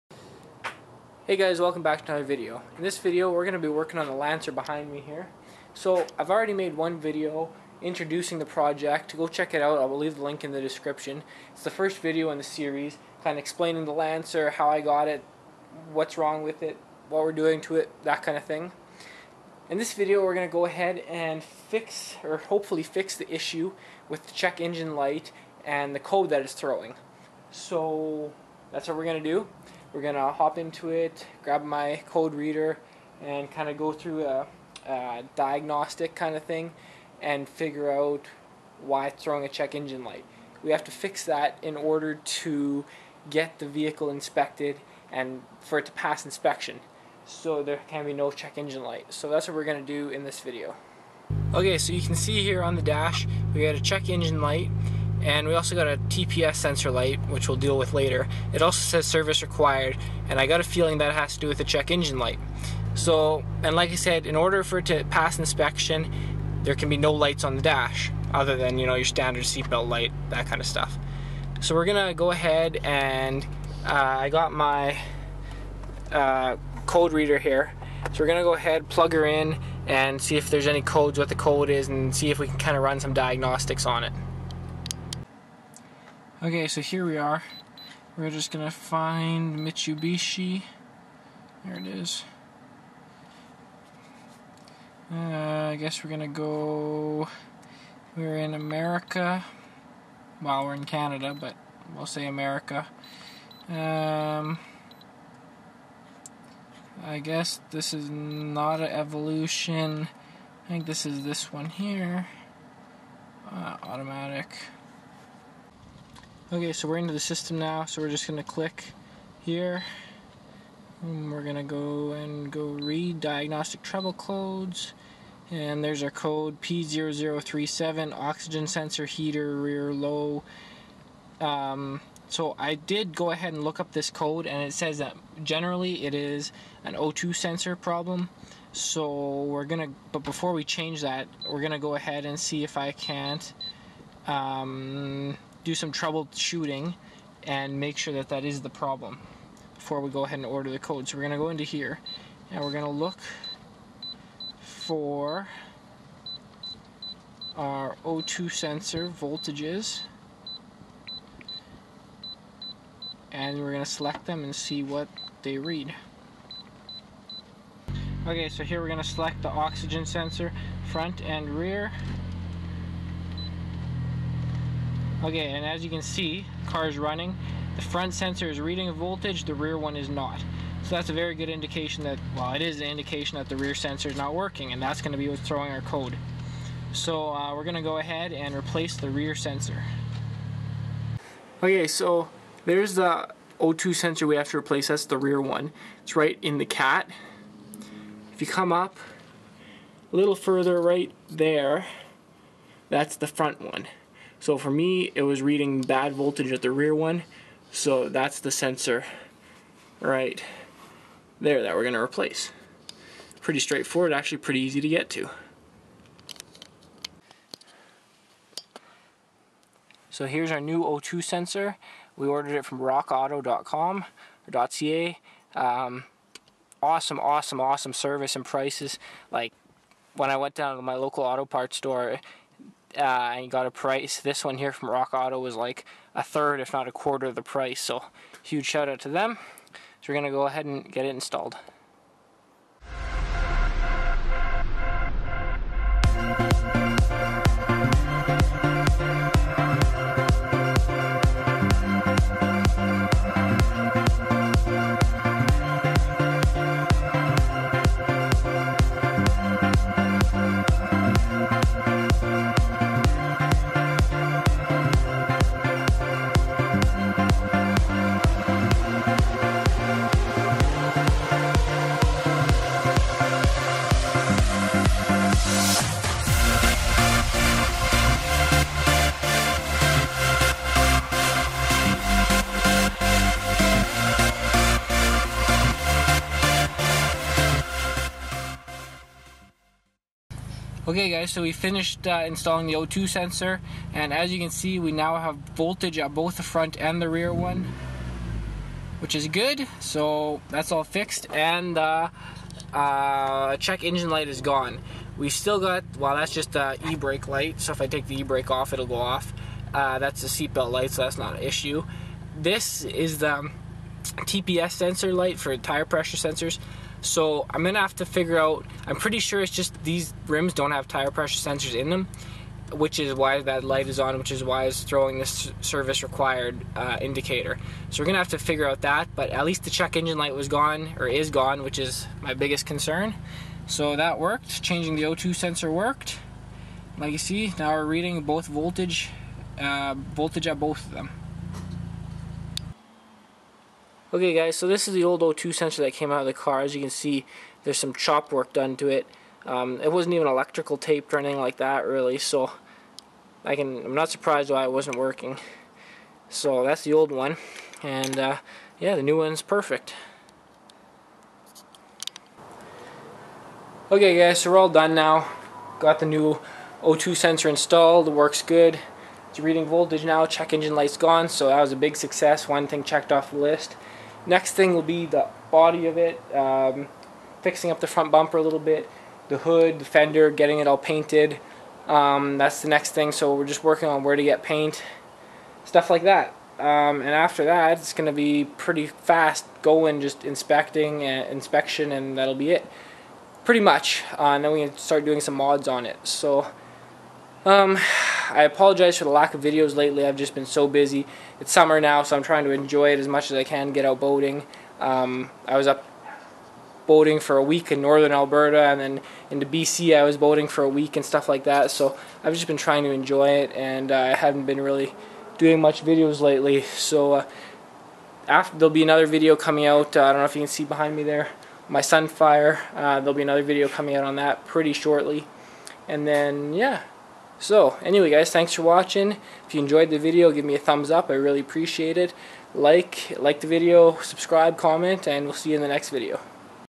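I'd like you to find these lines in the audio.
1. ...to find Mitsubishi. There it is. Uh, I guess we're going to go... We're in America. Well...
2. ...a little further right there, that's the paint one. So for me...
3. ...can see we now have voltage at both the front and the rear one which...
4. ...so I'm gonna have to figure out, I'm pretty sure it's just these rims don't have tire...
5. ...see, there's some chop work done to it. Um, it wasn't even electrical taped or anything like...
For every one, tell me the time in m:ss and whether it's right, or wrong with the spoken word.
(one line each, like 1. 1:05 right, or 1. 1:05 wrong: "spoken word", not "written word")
1. 1:28 right
2. 3:20 wrong: "front", not "paint"
3. 4:54 right
4. 5:17 right
5. 5:46 right.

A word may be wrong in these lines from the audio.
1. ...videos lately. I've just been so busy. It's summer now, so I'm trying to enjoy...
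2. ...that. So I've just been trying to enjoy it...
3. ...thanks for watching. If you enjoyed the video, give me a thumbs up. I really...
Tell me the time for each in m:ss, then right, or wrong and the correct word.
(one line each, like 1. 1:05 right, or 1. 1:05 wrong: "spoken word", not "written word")
1. 6:39 right
2. 6:51 right
3. 7:08 right.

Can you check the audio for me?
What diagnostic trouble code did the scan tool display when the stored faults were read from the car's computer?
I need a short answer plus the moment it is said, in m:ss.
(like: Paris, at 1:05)
P0037, at 2:06.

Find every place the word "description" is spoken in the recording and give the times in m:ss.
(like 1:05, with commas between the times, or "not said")
0:10.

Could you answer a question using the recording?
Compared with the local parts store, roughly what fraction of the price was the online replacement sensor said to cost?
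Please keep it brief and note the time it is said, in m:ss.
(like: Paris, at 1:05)
A third, at 3:56.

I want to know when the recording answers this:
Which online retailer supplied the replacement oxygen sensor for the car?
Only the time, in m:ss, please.
3:42.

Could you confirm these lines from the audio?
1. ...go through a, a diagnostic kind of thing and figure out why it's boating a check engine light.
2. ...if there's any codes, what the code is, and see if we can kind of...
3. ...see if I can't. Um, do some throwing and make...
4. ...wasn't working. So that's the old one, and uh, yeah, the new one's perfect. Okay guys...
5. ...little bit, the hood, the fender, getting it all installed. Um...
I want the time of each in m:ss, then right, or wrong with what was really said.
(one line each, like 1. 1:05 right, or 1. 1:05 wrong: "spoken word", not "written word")
1. 0:33 wrong: "throwing", not "boating"
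2. 1:20 right
3. 2:22 wrong: "troubleshooting", not "throwing"
4. 5:54 right
5. 6:18 wrong: "painted", not "installed".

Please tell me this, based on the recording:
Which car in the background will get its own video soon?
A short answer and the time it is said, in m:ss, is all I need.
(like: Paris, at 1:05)
Sunfire, at 7:01.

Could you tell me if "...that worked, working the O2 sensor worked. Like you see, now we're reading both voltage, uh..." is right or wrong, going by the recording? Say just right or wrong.
wrong.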